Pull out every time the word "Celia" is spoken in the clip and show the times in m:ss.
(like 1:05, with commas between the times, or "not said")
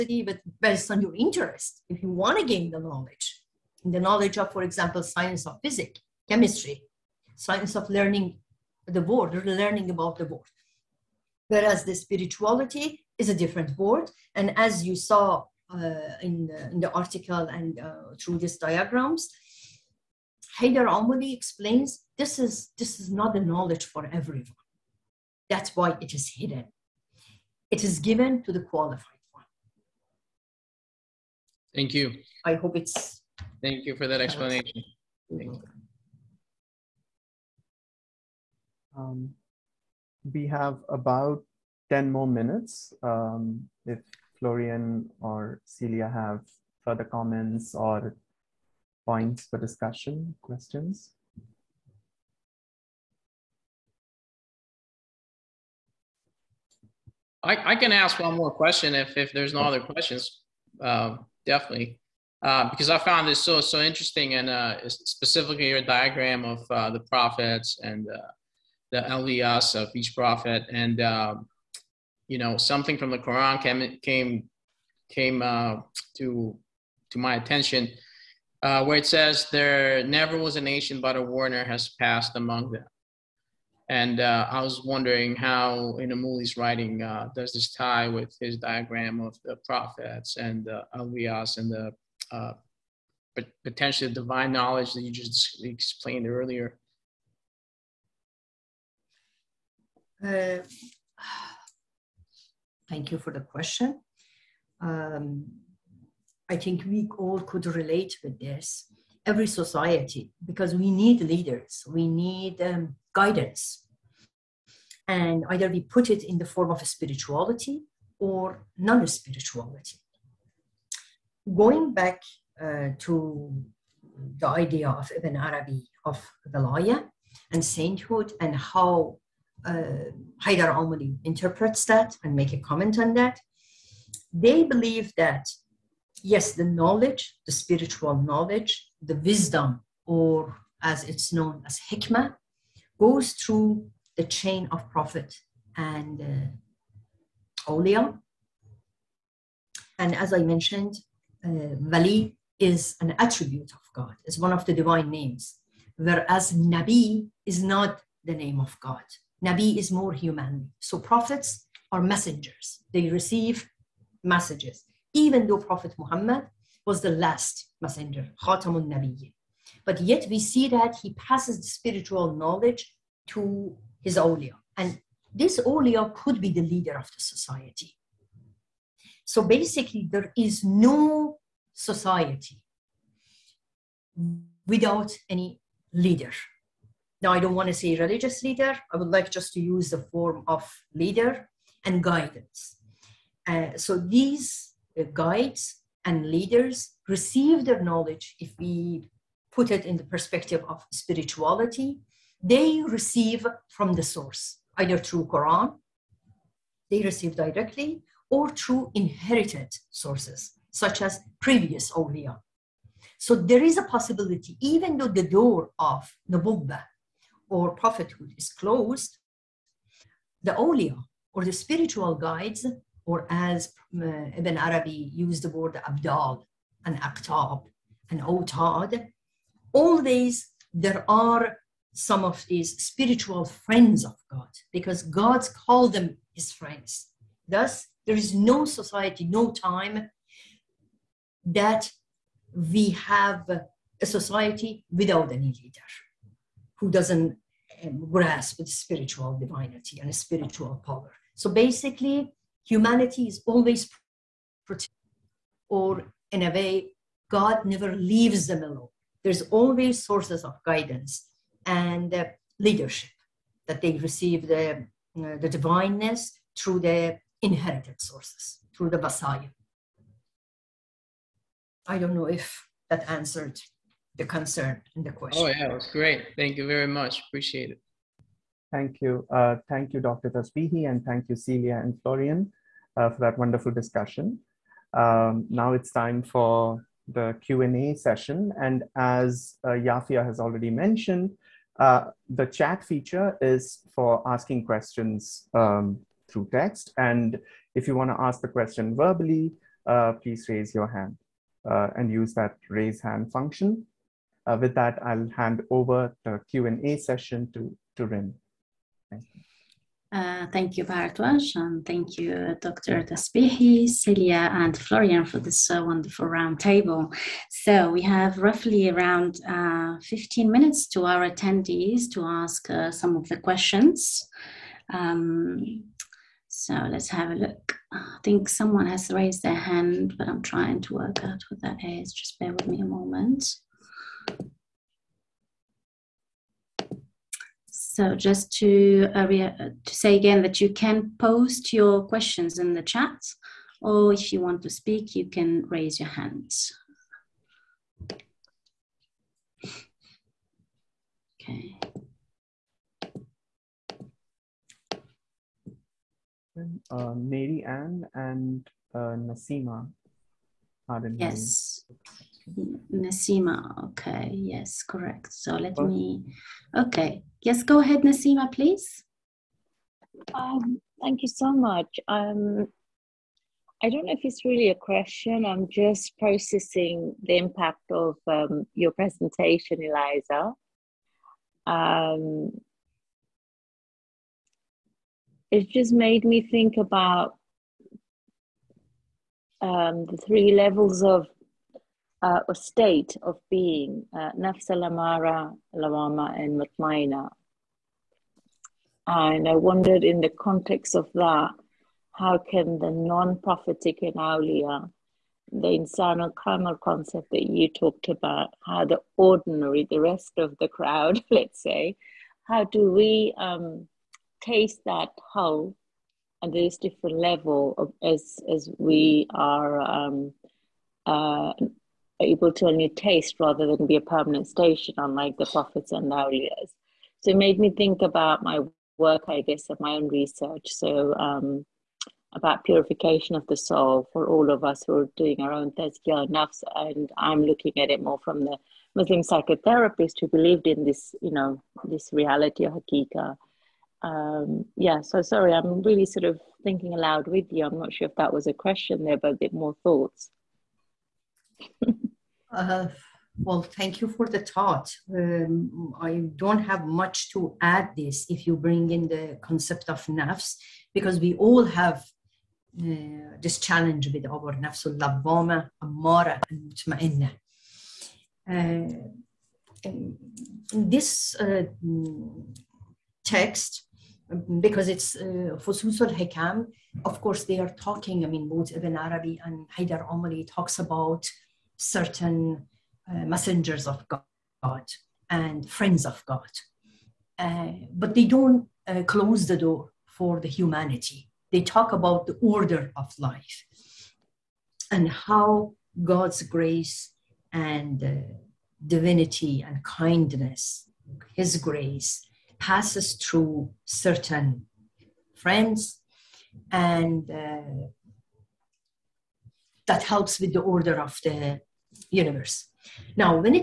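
0:45, 4:41, 5:13.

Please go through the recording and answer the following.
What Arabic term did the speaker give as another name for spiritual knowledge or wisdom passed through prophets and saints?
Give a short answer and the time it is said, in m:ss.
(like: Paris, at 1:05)
hikmah, at 2:21.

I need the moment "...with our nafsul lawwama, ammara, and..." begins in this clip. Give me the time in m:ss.
7:44.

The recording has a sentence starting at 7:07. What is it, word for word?
So it made me think about my work, I guess, of my own research.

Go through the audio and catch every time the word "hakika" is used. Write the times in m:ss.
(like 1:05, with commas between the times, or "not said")
7:22.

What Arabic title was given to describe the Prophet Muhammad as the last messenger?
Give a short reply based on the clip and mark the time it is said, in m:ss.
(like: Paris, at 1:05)
Khatamun Nabiyyin, at 2:48.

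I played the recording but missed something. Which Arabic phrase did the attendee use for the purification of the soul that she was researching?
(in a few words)
tazkiyah nafs.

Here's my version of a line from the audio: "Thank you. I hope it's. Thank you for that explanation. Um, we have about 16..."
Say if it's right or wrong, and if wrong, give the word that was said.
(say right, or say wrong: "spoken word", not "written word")
wrong: "10", not "16".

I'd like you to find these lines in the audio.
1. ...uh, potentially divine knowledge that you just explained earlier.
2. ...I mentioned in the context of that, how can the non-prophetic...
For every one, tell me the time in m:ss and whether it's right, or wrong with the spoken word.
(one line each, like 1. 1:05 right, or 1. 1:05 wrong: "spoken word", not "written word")
1. 1:33 right
2. 6:39 wrong: "wondered", not "mentioned".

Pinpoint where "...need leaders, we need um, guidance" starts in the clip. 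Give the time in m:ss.
1:50.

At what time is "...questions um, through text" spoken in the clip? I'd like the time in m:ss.
4:54.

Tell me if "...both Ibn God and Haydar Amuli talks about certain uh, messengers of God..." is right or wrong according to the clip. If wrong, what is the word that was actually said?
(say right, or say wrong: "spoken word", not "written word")
wrong: "Arabi", not "God".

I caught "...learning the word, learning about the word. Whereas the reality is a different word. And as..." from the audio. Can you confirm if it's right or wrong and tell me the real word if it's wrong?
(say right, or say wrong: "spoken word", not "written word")
wrong: "spirituality", not "reality".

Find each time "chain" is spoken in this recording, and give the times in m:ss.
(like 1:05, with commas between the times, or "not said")
2:24.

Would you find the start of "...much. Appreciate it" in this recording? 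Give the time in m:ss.
4:36.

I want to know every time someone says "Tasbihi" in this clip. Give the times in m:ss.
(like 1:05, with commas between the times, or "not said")
4:40, 5:13.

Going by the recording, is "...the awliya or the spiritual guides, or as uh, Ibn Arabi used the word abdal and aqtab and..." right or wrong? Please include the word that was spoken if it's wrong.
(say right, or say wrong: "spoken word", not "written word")
right.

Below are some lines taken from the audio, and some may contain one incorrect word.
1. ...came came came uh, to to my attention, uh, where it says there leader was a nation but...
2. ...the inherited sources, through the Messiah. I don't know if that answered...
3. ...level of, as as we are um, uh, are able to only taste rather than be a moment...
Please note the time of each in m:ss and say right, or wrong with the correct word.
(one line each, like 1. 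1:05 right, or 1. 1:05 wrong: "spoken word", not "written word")
1. 1:13 wrong: "never", not "leader"
2. 4:26 right
3. 6:57 wrong: "permanent", not "moment".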